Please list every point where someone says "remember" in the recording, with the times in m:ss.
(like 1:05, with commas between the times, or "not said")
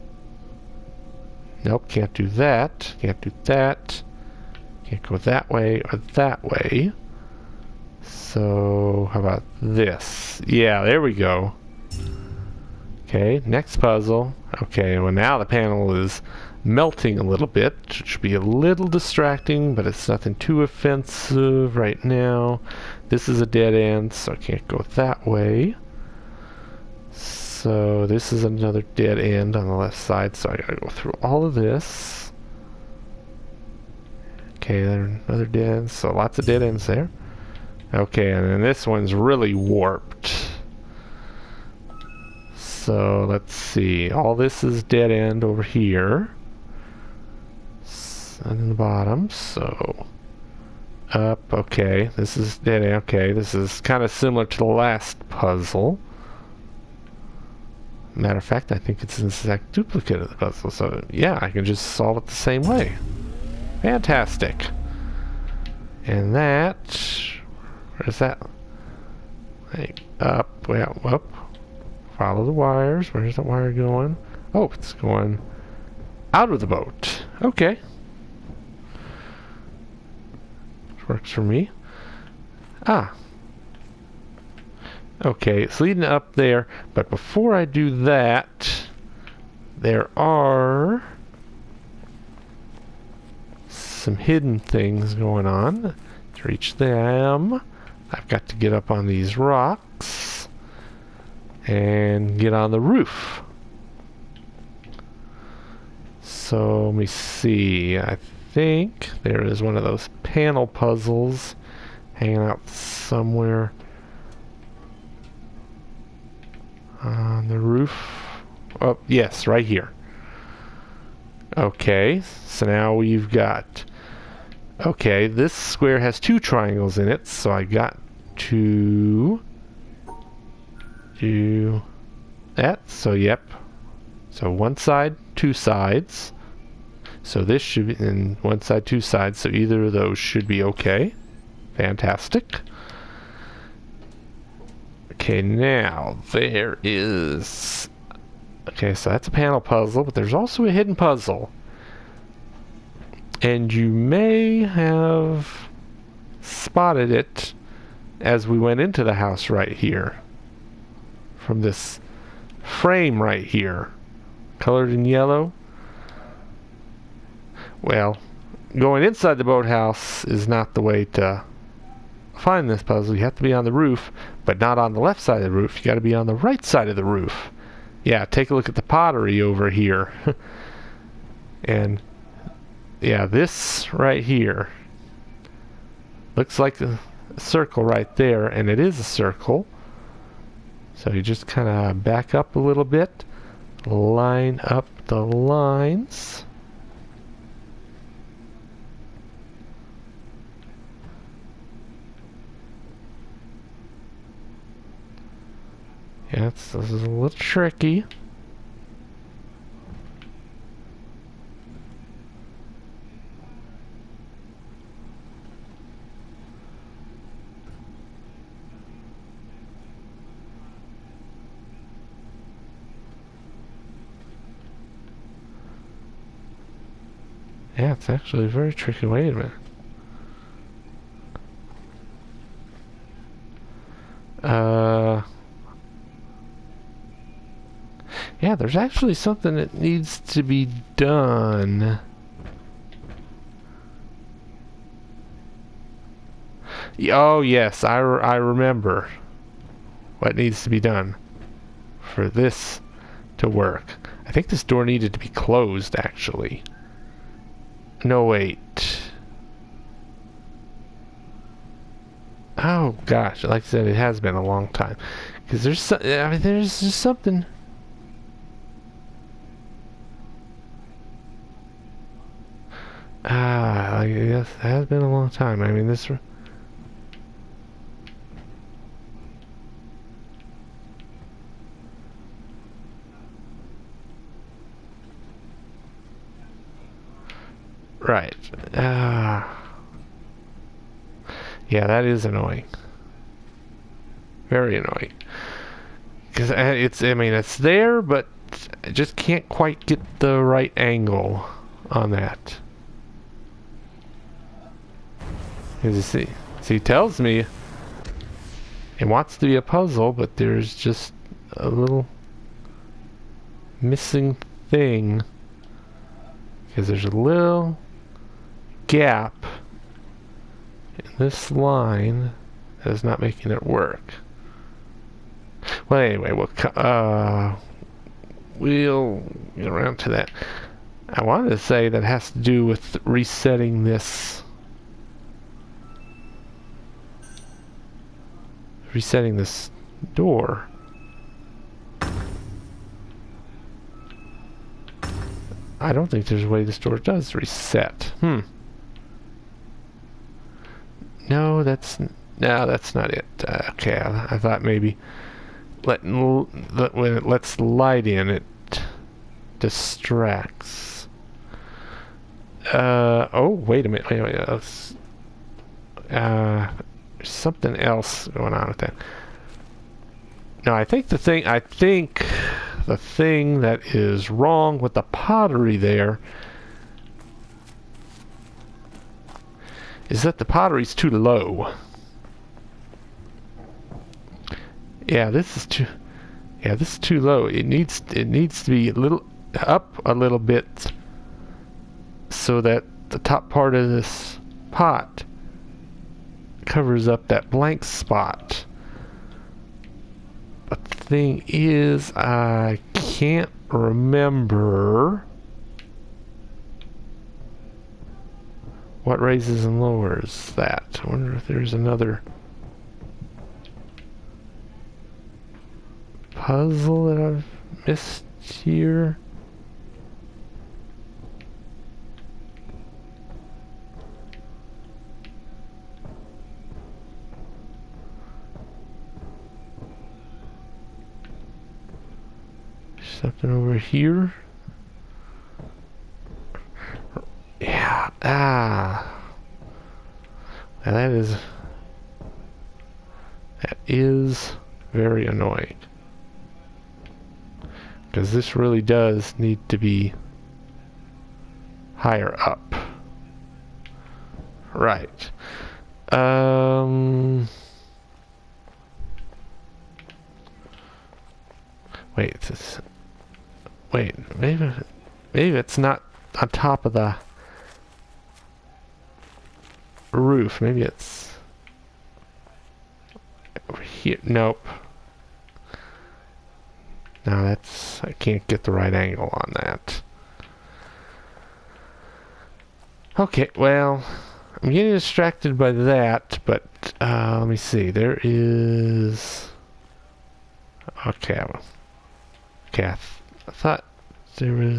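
4:08, 6:43.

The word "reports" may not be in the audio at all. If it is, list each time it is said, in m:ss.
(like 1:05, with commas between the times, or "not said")
not said.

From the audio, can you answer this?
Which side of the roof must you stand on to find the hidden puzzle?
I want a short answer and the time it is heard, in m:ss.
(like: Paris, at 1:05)
right side, at 2:56.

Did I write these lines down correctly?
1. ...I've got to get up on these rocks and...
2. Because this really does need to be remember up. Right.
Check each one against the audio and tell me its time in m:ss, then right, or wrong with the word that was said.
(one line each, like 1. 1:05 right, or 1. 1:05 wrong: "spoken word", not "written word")
1. 1:38 right
2. 7:28 wrong: "higher", not "remember".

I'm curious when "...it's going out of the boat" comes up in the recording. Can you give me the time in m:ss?
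1:14.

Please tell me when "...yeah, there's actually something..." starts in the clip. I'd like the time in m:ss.
3:58.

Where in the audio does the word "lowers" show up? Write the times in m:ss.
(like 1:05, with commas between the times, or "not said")
6:49.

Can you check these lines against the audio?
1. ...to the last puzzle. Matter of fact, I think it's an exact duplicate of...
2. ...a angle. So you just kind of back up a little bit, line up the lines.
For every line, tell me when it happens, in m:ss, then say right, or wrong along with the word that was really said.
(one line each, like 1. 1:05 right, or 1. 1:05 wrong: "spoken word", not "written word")
1. 0:54 right
2. 3:08 wrong: "circle", not "angle".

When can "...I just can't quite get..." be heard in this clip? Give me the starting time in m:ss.
4:58.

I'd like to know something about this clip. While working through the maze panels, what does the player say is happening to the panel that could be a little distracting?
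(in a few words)
melting.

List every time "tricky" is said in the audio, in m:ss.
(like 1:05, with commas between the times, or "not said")
3:27, 3:48.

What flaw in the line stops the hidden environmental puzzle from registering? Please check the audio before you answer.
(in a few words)
a little gap.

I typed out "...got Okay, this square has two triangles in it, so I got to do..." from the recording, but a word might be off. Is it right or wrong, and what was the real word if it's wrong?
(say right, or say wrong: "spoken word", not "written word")
right.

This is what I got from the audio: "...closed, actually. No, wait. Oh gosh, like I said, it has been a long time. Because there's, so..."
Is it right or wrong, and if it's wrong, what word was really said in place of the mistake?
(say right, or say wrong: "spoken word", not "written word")
right.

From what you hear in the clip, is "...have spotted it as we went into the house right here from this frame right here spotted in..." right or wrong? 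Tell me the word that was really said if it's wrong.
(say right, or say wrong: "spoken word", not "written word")
wrong: "colored", not "spotted".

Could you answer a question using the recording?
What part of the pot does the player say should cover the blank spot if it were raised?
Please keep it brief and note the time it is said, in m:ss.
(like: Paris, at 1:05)
top part, at 6:33.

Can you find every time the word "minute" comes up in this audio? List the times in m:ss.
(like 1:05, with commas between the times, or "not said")
3:49, 6:03.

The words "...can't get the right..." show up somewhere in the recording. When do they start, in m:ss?
7:58.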